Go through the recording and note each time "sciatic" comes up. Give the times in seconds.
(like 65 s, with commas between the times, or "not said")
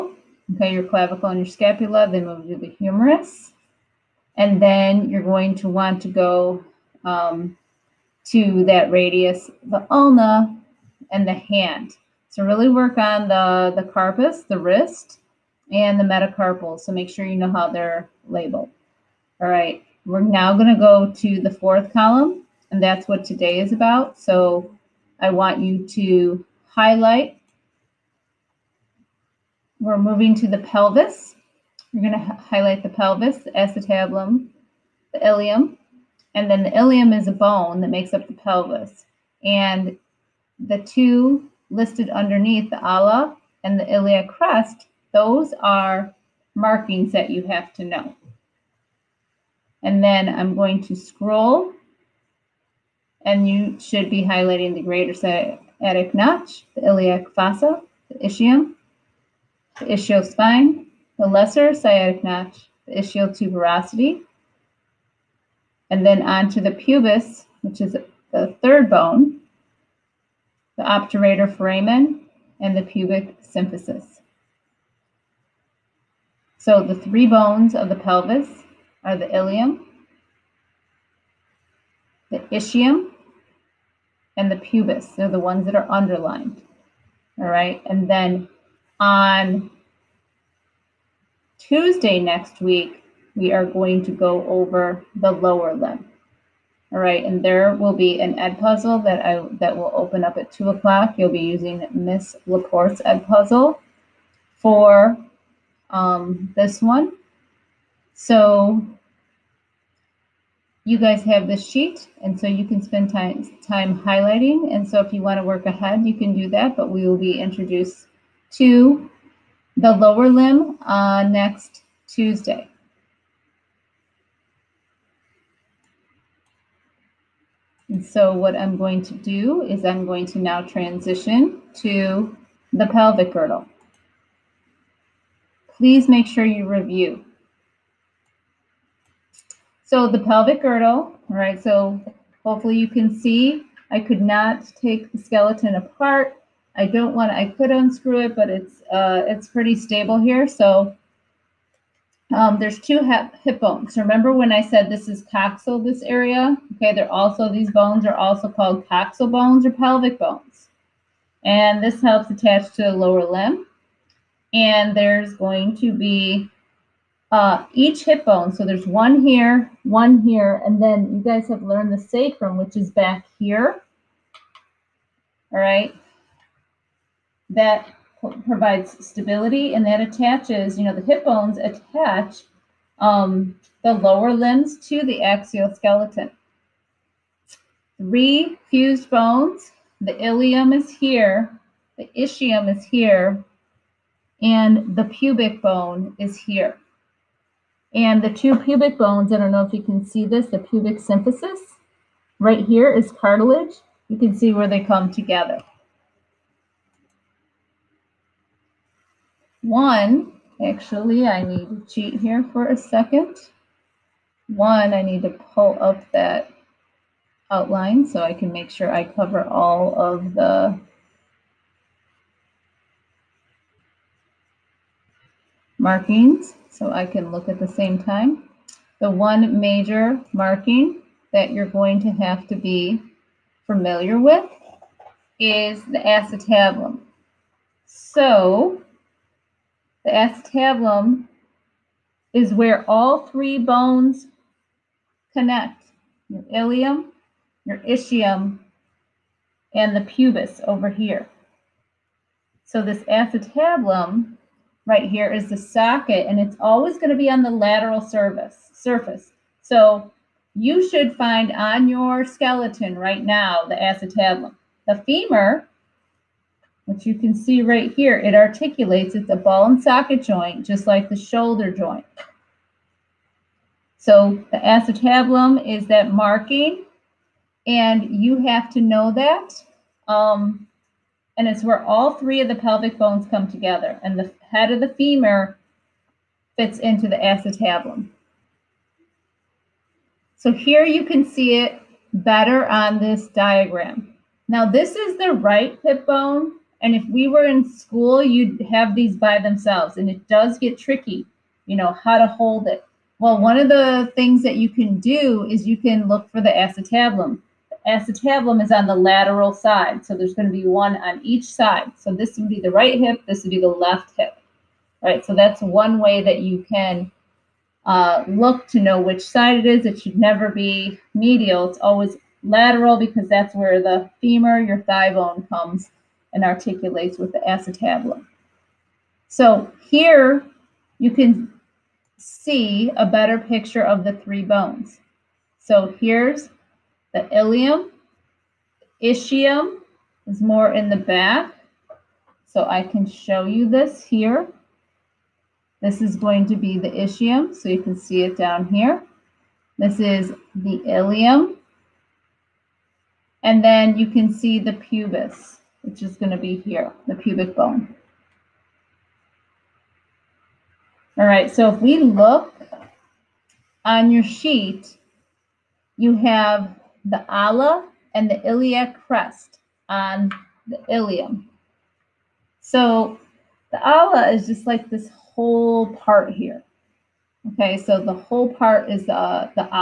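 55 s, 61 s.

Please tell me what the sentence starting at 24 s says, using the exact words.
So I want you to highlight we're moving to the pelvis.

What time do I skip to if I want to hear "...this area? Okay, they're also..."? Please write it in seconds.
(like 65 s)
155 s.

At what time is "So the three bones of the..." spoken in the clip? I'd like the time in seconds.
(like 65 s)
76 s.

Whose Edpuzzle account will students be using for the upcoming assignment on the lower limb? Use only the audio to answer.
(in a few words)
Miss Laporte's.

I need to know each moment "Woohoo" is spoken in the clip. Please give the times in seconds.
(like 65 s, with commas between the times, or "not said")
not said.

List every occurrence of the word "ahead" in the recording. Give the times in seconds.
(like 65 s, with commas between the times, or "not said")
115 s.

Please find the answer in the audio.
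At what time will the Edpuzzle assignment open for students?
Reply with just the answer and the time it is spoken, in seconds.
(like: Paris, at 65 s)
2 o'clock, at 100 s.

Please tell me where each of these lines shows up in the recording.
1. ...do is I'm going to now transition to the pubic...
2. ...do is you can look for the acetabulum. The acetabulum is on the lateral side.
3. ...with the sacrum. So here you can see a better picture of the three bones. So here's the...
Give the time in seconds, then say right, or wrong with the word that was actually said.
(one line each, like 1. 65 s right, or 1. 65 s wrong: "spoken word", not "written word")
1. 129 s wrong: "pelvic", not "pubic"
2. 304 s right
3. 327 s wrong: "acetabulum", not "sacrum".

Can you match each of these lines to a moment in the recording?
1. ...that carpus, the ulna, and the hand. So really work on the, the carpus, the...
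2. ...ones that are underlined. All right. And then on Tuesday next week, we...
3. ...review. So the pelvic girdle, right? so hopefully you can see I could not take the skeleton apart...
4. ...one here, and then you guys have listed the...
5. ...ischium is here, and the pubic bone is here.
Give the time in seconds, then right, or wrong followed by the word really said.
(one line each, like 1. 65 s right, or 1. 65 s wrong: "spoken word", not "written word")
1. 8 s wrong: "radius", not "carpus"
2. 85 s right
3. 136 s right
4. 169 s wrong: "learned", not "listed"
5. 192 s right.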